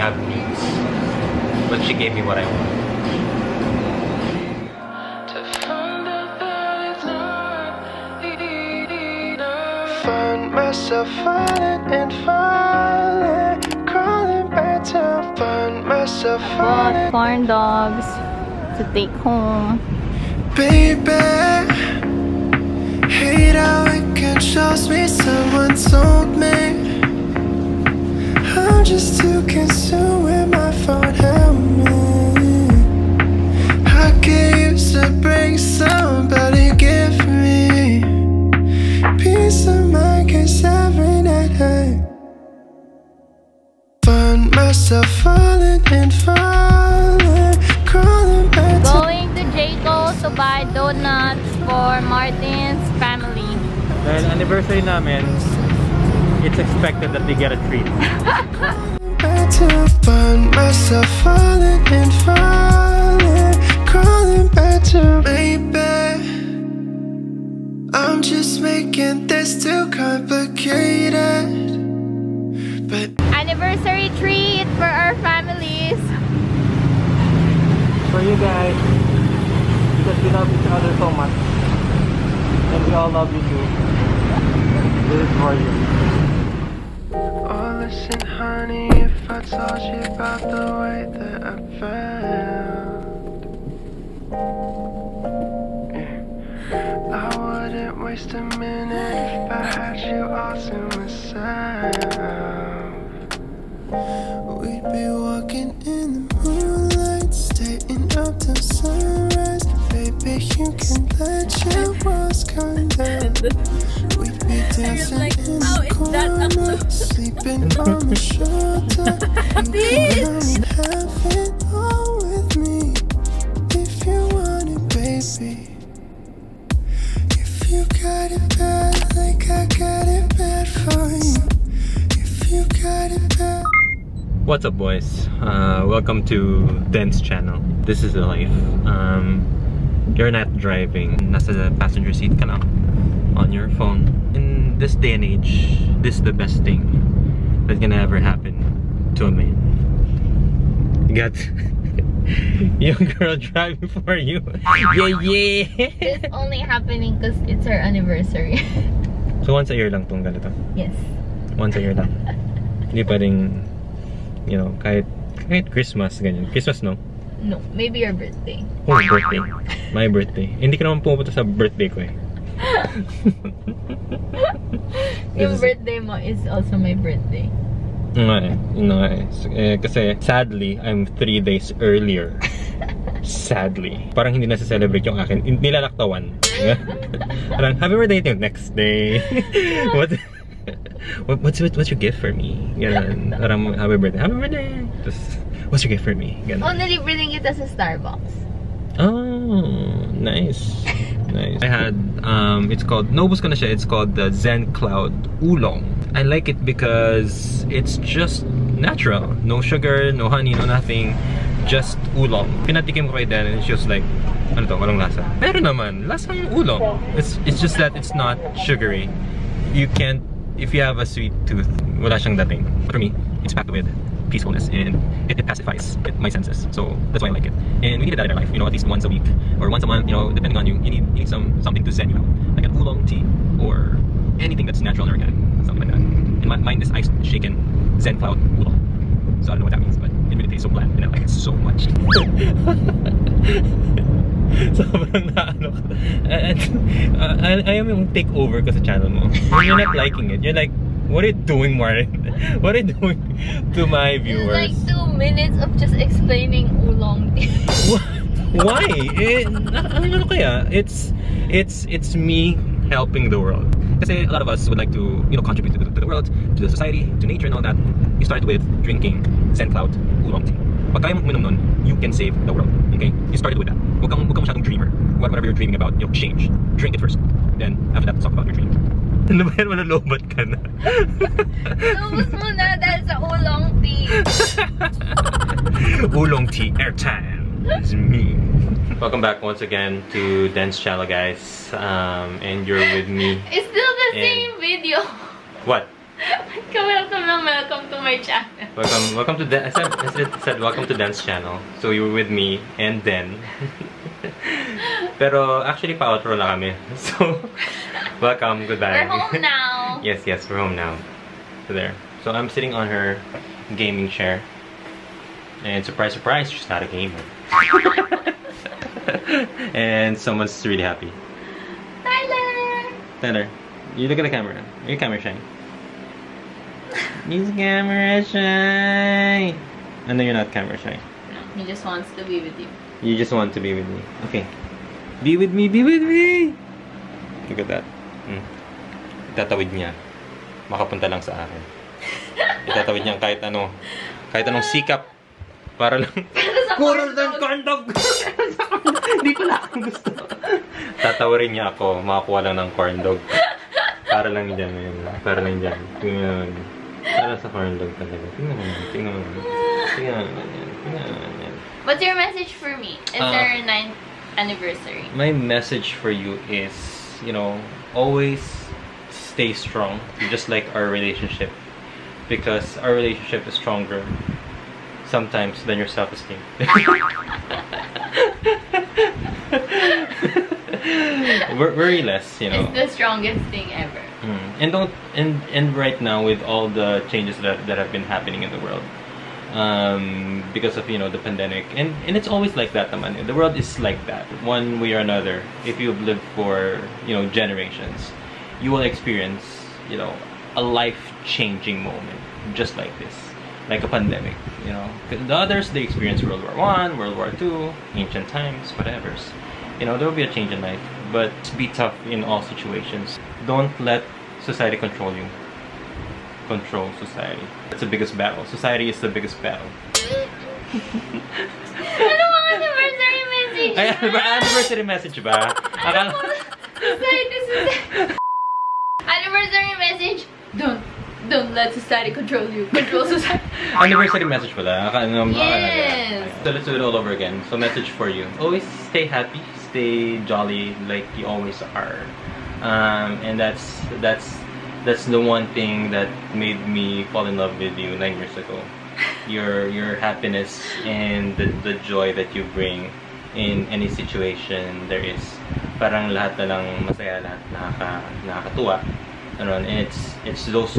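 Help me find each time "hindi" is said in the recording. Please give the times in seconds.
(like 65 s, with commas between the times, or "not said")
162 s, 170 s, 184 s, 349 s.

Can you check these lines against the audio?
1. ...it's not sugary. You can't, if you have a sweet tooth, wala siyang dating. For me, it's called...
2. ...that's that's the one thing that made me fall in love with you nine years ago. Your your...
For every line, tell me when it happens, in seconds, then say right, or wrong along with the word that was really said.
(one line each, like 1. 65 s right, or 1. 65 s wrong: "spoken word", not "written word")
1. 217 s wrong: "packed", not "called"
2. 444 s right.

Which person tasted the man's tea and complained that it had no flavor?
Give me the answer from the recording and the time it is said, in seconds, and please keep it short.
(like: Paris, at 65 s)
Den, at 213 s.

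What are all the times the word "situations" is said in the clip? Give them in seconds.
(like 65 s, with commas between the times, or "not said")
412 s, 453 s.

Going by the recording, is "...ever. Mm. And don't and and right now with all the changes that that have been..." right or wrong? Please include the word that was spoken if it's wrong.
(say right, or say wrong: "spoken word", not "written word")
right.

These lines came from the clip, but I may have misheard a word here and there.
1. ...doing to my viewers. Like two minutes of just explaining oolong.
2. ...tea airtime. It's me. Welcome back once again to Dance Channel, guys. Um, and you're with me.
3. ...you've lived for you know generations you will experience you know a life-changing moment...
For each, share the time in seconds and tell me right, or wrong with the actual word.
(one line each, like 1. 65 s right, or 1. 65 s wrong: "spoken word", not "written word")
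1. 252 s right
2. 286 s right
3. 395 s right.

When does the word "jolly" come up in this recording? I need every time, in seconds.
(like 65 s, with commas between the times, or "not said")
440 s.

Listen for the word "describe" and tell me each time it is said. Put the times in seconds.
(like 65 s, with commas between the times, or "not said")
not said.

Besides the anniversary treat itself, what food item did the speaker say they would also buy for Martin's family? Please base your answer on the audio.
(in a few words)
donuts.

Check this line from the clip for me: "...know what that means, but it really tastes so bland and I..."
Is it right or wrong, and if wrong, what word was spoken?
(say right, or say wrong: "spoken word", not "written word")
right.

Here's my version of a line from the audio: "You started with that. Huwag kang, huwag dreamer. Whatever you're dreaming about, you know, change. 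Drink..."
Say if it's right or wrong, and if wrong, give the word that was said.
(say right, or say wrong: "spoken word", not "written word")
right.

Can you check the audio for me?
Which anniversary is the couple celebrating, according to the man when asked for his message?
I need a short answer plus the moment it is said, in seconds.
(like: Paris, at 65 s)
9th, at 363 s.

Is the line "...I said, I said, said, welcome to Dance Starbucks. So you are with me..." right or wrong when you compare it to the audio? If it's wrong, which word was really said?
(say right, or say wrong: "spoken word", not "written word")
wrong: "Channel", not "Starbucks".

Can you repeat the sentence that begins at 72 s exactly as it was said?
But anniversary treat for our families.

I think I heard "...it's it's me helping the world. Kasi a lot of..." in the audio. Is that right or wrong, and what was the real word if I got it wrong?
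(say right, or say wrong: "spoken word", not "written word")
right.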